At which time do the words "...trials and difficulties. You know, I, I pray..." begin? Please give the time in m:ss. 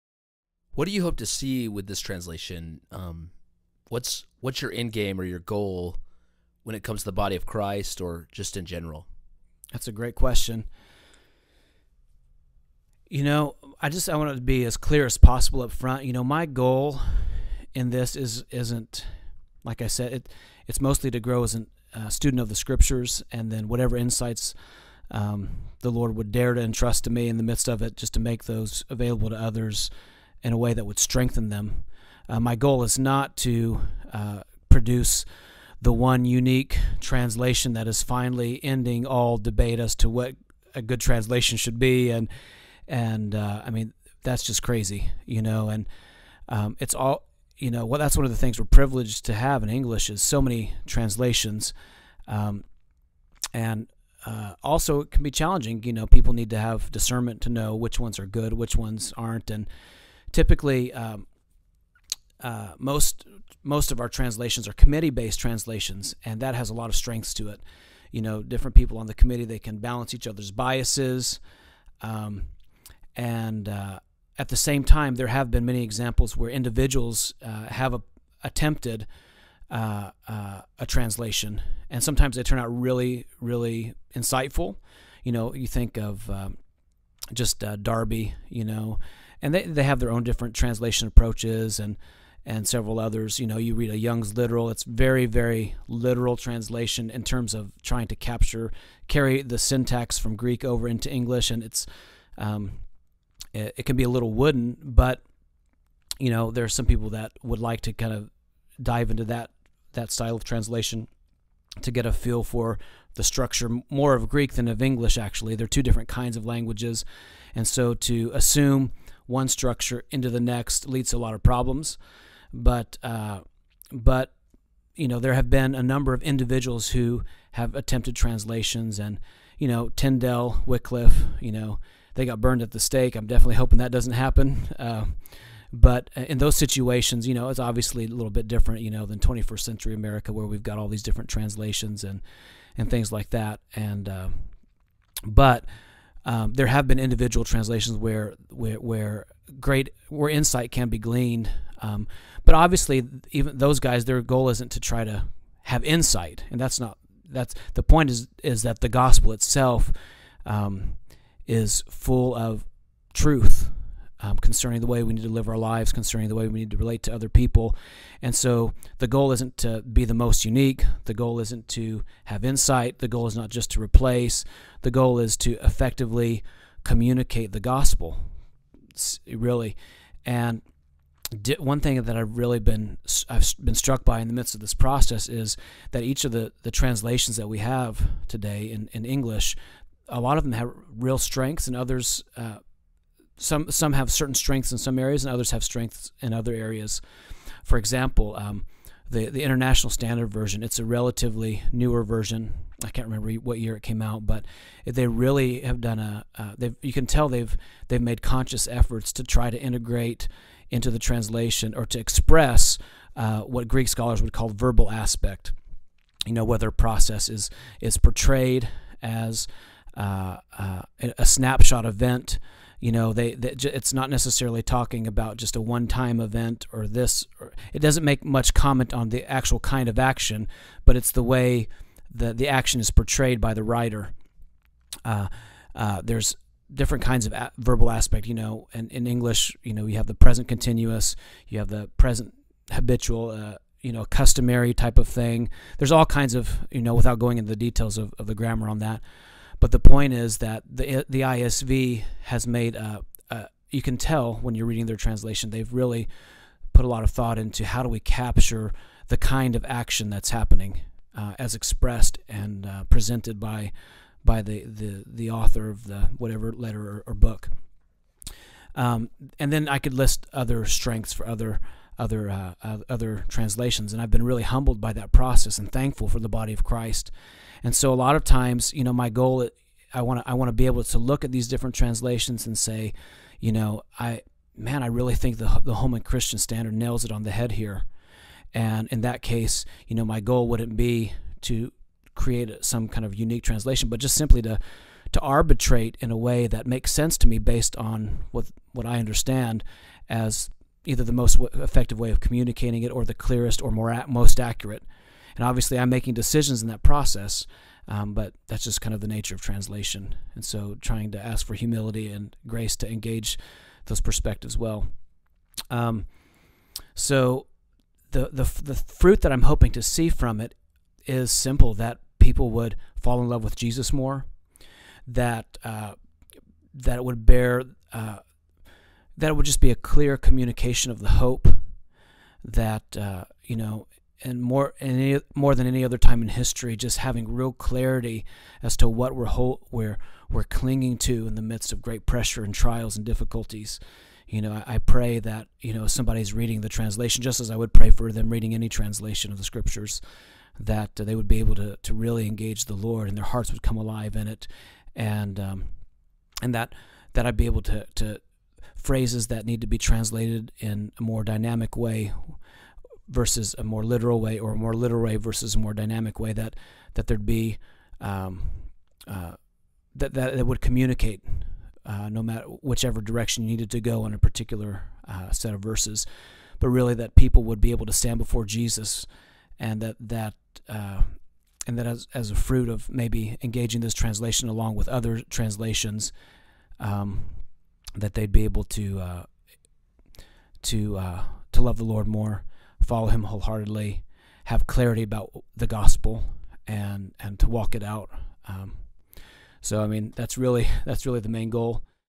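5:42.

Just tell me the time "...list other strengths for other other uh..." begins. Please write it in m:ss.
4:29.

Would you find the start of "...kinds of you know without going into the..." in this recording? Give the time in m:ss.
4:06.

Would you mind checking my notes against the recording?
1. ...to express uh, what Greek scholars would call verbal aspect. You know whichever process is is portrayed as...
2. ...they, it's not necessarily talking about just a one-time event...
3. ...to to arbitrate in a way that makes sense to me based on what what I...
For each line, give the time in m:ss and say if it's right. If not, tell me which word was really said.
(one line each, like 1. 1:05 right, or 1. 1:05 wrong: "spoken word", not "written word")
1. 3:31 wrong: "whether", not "whichever"
2. 3:43 right
3. 4:54 right.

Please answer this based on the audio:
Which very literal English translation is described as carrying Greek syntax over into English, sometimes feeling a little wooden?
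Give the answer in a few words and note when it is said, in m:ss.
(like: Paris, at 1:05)
Young's Literal, at 1:33.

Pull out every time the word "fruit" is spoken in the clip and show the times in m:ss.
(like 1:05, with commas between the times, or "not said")
5:18, 6:22.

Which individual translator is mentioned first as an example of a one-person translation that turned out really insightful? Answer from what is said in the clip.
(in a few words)
Darby.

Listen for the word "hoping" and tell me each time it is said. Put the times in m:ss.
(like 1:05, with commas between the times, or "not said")
2:13, 5:19.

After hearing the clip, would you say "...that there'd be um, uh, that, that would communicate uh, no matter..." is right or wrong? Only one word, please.
right.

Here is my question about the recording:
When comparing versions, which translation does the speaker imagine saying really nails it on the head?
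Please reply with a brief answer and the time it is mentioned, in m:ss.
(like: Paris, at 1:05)
Holman Christian Standard, at 4:45.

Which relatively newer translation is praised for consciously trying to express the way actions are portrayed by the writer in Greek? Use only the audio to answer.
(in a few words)
International Standard Version.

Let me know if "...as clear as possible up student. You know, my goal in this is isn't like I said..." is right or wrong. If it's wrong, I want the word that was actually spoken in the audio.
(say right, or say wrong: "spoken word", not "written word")
wrong: "front", not "student".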